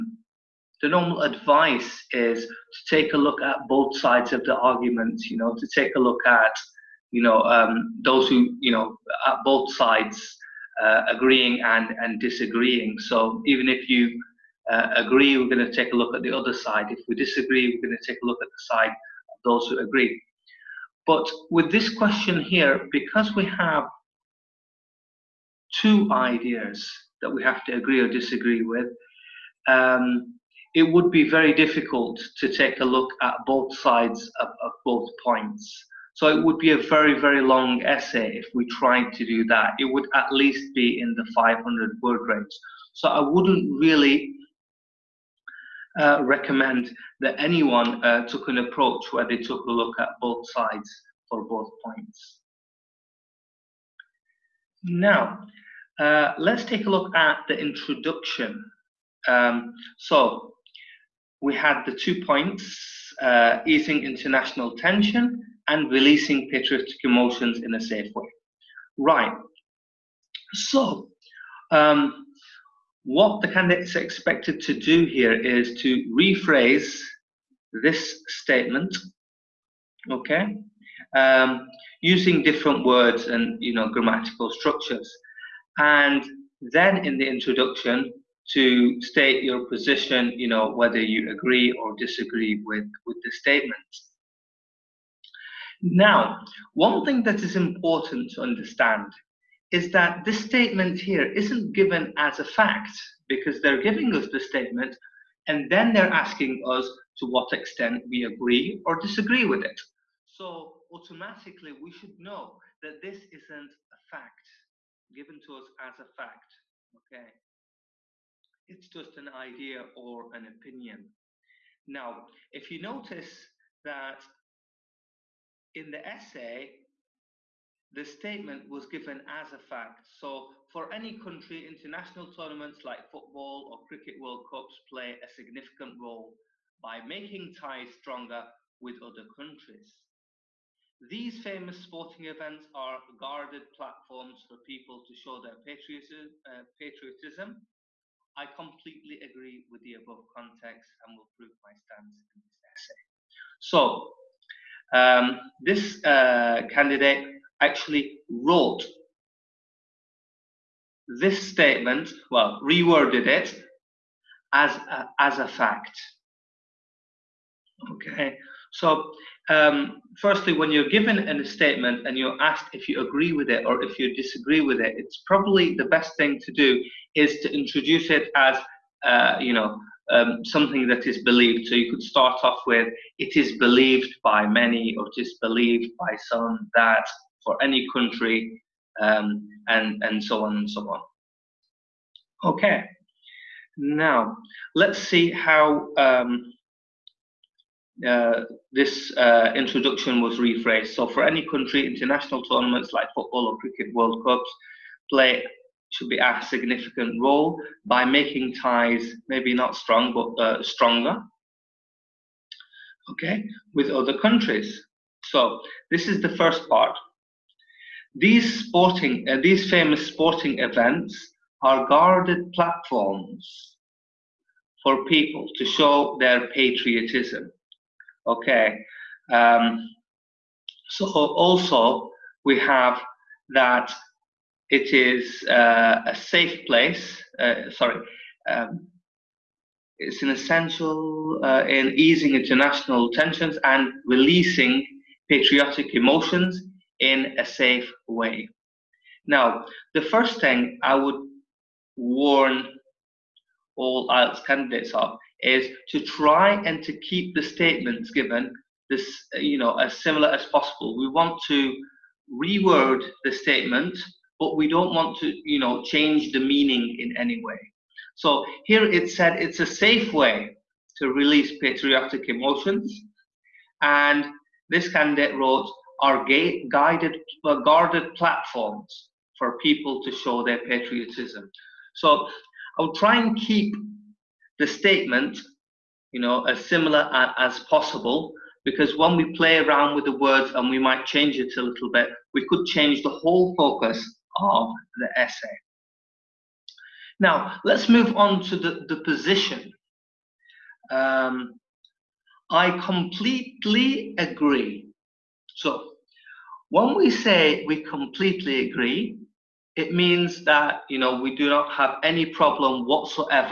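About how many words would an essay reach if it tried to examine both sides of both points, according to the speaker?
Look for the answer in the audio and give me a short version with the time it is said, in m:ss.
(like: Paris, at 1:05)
500, at 0:41.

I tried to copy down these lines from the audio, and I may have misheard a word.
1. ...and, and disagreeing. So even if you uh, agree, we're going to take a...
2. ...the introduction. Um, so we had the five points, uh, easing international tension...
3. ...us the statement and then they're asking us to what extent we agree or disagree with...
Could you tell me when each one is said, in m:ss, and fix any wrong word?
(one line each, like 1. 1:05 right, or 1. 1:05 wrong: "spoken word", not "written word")
1. 0:11 right
2. 0:57 wrong: "two", not "five"
3. 1:44 right.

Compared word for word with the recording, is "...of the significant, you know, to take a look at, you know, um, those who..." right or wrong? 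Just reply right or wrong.
wrong.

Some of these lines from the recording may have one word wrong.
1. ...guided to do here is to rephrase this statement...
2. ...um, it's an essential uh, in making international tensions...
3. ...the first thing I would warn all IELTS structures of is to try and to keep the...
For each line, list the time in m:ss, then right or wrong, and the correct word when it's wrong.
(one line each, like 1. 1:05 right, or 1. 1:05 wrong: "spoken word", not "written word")
1. 1:13 wrong: "expected", not "guided"
2. 3:58 wrong: "easing", not "making"
3. 4:09 wrong: "candidates", not "structures".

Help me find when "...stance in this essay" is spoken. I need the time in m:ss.
2:31.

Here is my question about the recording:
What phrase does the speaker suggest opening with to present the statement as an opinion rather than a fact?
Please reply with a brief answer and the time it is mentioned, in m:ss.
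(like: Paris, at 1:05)
it is believed by many, at 3:03.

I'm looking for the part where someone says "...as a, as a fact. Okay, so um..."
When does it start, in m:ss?
2:44.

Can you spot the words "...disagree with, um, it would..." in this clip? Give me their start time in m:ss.
0:28.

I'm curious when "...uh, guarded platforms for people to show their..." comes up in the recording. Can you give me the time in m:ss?
4:37.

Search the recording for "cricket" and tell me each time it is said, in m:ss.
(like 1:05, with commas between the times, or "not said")
2:13, 3:23.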